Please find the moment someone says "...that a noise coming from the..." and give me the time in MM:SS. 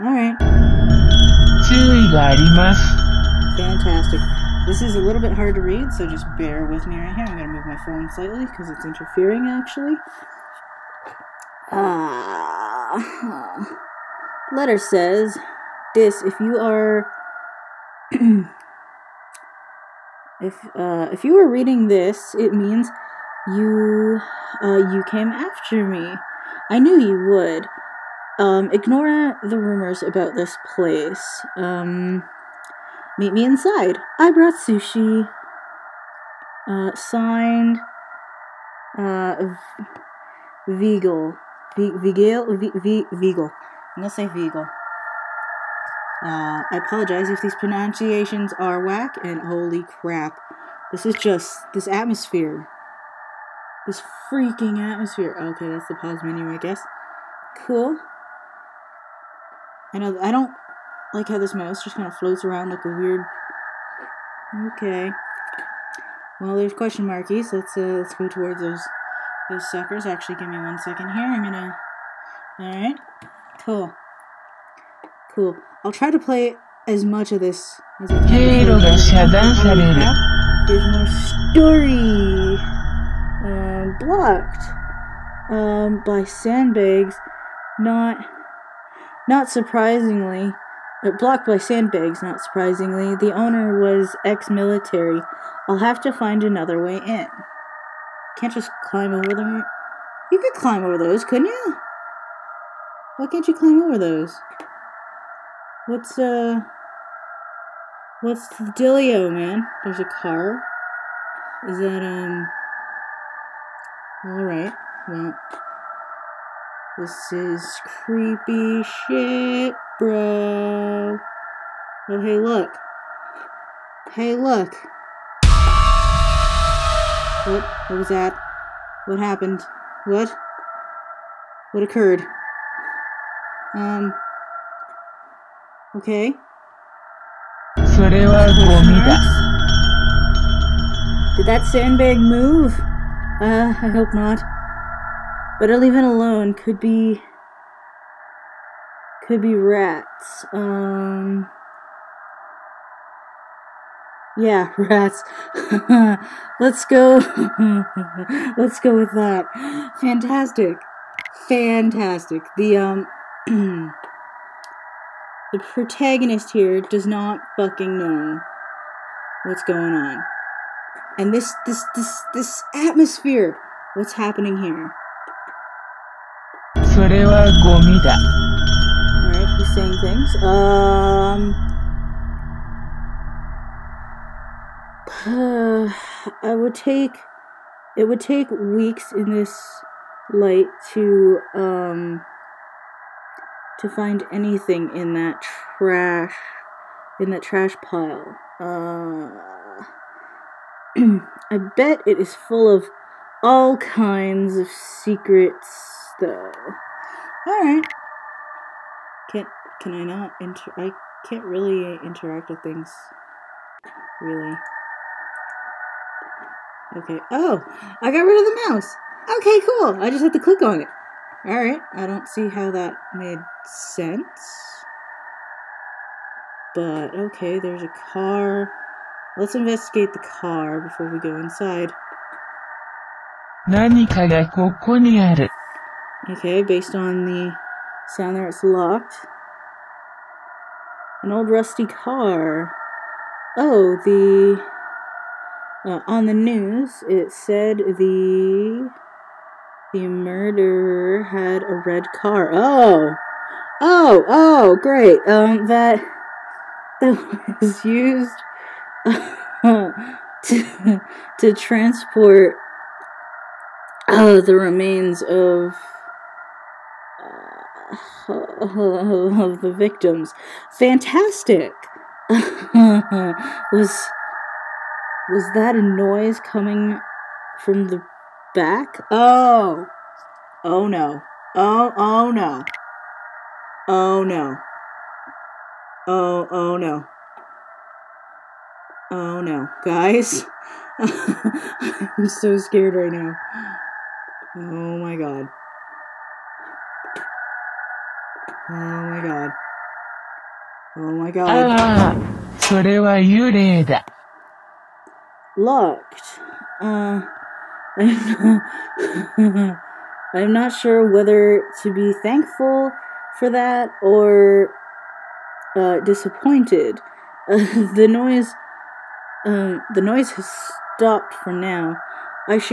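04:35.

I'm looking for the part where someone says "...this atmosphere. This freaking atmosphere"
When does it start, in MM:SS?
00:51.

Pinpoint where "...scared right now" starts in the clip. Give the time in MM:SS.
04:52.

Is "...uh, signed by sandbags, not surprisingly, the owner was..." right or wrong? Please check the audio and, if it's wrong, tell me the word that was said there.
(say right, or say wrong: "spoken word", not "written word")
wrong: "blocked", not "signed".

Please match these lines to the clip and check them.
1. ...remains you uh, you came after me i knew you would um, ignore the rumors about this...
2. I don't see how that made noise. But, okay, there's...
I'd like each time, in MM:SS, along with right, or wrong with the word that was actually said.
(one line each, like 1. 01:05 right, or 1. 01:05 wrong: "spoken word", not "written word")
1. 00:22 wrong: "means", not "remains"
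2. 03:41 wrong: "sense", not "noise".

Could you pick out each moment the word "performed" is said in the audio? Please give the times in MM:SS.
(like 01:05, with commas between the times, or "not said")
not said.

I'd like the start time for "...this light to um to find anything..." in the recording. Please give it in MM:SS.
03:09.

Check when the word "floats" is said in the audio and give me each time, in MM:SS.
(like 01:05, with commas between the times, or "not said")
01:02.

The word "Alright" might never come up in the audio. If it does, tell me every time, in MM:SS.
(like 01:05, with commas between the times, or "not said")
01:12, 01:54, 02:56.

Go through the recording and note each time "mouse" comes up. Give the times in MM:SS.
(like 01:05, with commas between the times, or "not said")
01:01, 03:38.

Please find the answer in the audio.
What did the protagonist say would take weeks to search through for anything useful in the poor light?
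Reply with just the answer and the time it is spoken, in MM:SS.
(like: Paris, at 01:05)
Trash pile, at 03:17.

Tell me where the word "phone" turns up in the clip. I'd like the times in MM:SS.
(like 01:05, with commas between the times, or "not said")
00:07.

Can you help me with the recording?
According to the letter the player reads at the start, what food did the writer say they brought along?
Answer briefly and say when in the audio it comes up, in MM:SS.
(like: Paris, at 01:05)
Sushi, at 00:34.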